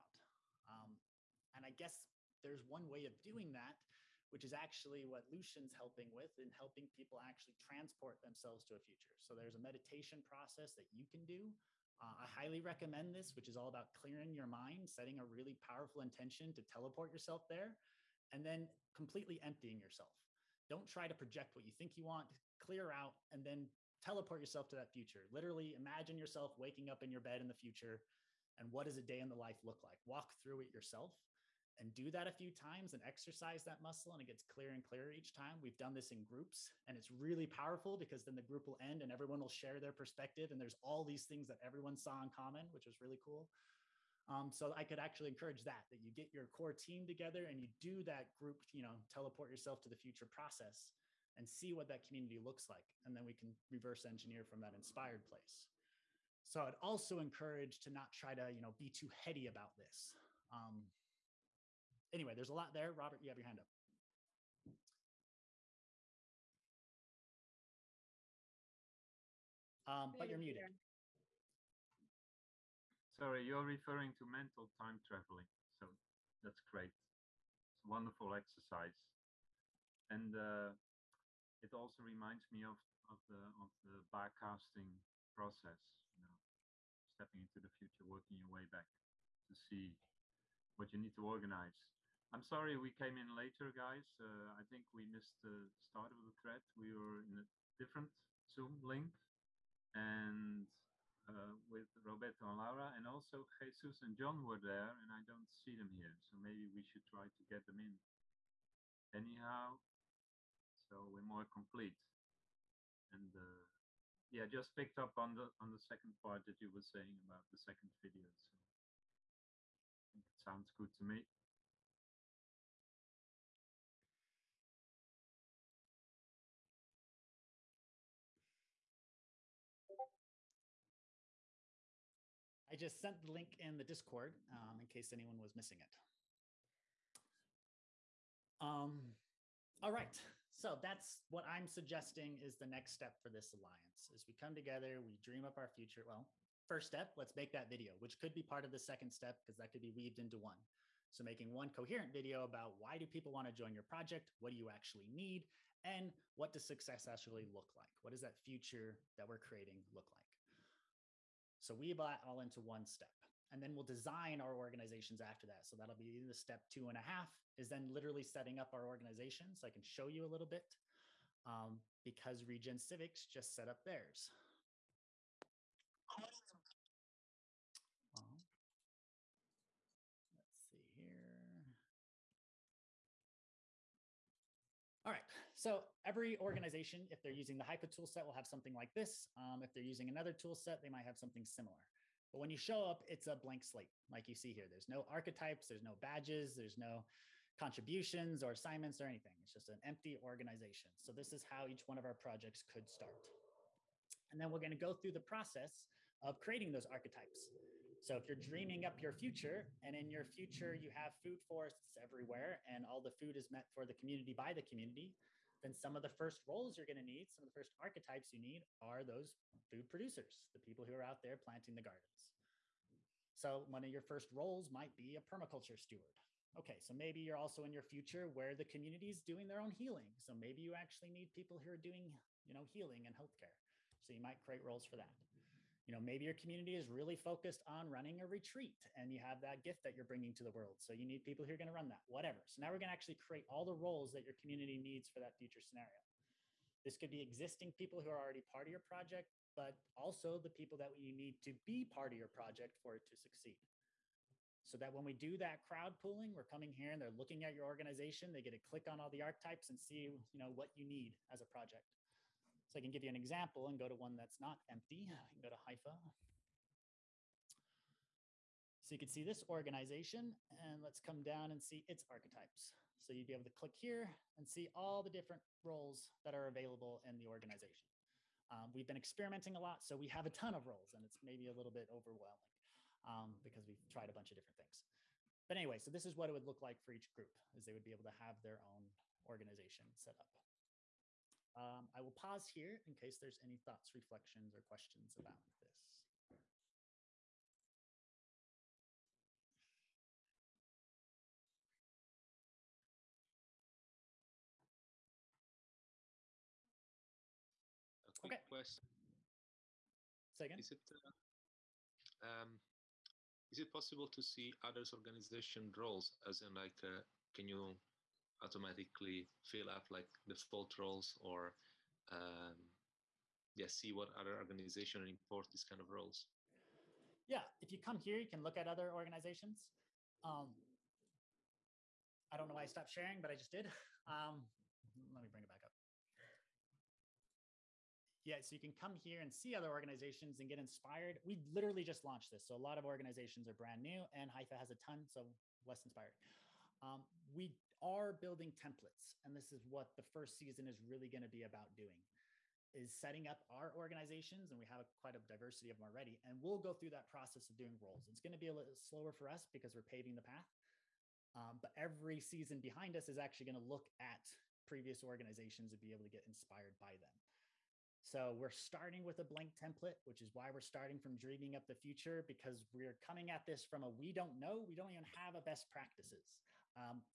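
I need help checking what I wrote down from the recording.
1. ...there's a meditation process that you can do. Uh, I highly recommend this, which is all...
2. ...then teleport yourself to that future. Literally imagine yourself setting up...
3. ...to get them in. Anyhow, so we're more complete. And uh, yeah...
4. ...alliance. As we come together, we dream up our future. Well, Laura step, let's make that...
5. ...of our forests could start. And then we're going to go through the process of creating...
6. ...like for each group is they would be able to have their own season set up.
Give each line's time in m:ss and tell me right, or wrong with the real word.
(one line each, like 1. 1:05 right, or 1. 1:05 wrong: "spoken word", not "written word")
1. 0:09 right
2. 0:23 wrong: "waking", not "setting"
3. 1:47 right
4. 2:23 wrong: "First", not "Laura"
5. 3:21 wrong: "projects", not "forests"
6. 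4:46 wrong: "organization", not "season".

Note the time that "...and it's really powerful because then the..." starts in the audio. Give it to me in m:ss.
0:36.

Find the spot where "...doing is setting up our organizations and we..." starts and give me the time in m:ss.
5:51.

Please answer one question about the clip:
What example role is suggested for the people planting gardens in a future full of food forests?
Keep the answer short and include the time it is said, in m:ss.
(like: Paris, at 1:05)
Permaculture steward, at 3:45.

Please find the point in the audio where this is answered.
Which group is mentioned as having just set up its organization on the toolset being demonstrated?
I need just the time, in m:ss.
2:52.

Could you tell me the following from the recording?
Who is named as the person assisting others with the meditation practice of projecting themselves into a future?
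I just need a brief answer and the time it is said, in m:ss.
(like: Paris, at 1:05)
Lucian, at 0:05.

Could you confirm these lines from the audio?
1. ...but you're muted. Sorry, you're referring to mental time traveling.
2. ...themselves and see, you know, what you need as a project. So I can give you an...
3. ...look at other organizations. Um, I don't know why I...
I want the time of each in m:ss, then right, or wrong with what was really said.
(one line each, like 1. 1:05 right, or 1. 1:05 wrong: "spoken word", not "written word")
1. 1:10 right
2. 4:19 wrong: "archetypes", not "themselves"
3. 5:28 right.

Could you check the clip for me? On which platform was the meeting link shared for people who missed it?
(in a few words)
Discord.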